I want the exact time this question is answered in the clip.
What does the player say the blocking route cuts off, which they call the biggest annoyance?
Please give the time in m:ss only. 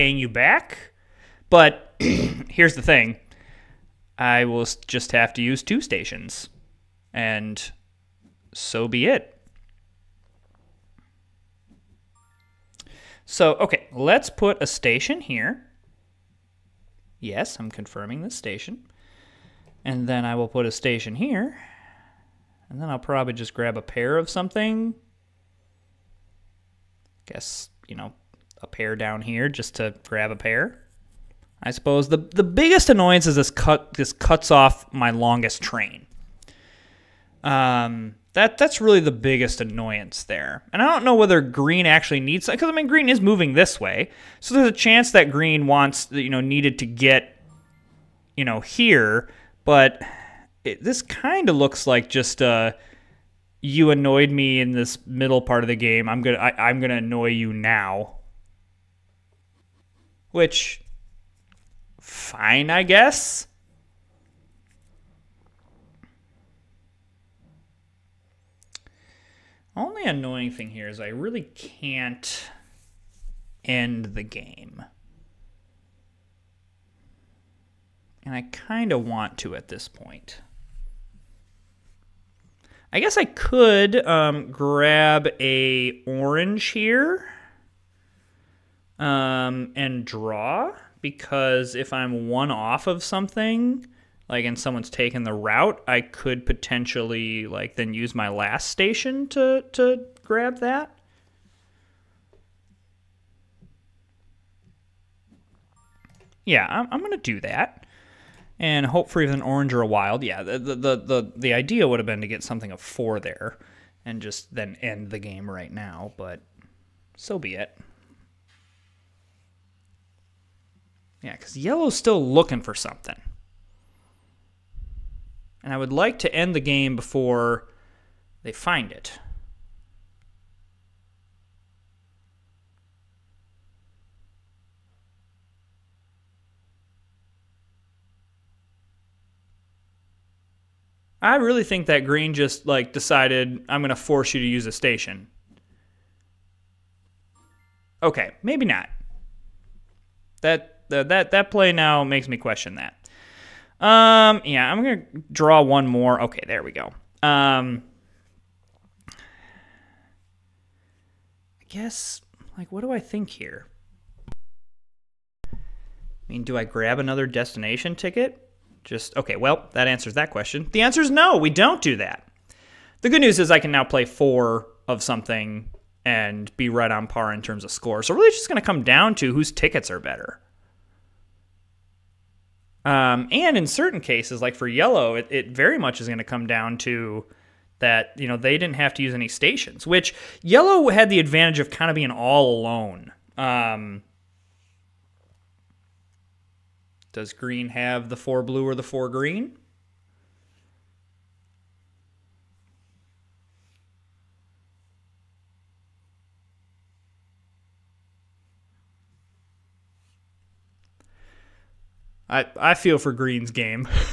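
0:35.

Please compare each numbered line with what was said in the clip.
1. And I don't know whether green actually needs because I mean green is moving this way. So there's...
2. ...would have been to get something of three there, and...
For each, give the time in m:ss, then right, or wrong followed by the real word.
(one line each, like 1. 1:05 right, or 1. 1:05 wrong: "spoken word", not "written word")
1. 0:40 right
2. 1:51 wrong: "four", not "three".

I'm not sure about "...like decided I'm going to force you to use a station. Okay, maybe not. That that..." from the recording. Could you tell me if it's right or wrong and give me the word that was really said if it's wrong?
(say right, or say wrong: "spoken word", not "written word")
right.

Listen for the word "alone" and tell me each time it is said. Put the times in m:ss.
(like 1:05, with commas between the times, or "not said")
3:12.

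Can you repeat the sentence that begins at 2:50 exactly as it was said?
The answer is no, we don't do that.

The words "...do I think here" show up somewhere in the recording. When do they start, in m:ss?
2:42.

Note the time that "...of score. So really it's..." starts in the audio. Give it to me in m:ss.
2:57.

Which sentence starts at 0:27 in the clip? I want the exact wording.
Guess, you know, a pair down here just to grab a pair.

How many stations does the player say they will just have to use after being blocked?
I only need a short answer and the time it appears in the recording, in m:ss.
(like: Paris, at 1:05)
2, at 0:05.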